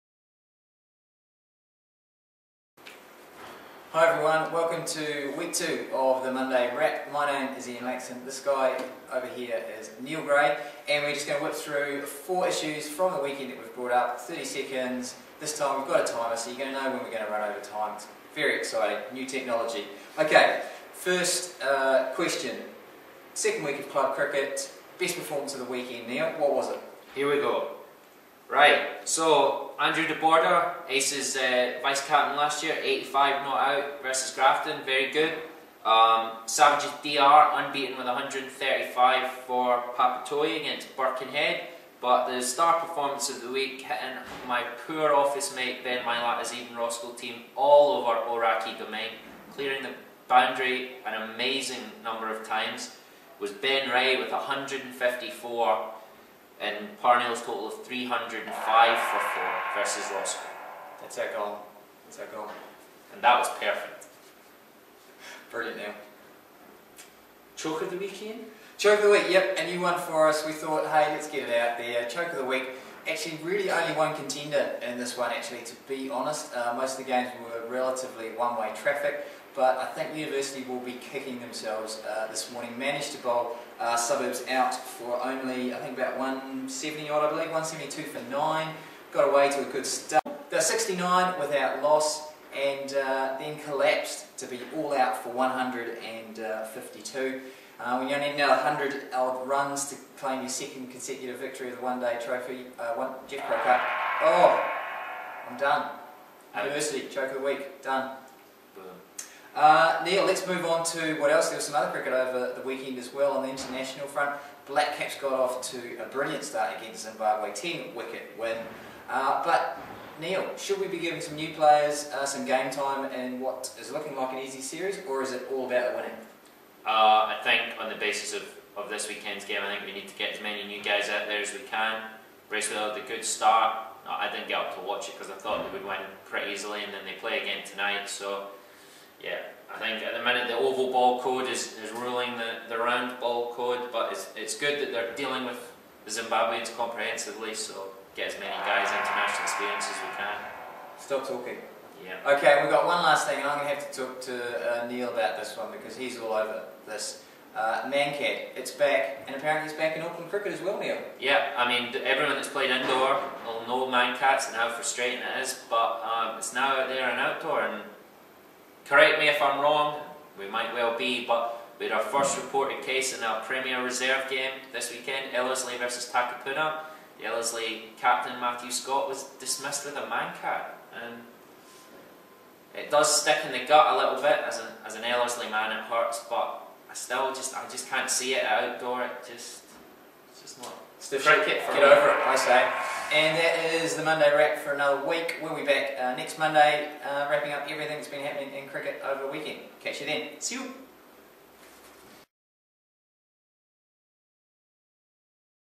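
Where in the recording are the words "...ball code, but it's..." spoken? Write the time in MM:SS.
02:23.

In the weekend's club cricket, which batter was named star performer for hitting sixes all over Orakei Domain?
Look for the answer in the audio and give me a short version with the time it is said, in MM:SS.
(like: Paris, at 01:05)
Ben Rae, at 00:53.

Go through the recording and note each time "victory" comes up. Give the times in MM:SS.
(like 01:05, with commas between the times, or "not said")
01:41.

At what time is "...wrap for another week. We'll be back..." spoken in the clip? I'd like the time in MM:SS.
03:14.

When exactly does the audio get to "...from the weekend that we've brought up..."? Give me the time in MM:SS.
00:12.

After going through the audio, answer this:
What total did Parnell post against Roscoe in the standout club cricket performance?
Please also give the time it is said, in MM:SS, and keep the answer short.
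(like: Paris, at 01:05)
305 for 4, at 00:57.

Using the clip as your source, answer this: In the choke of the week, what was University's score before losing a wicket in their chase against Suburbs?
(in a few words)
69.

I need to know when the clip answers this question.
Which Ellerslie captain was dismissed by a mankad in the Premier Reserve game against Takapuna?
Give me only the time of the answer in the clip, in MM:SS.
02:58.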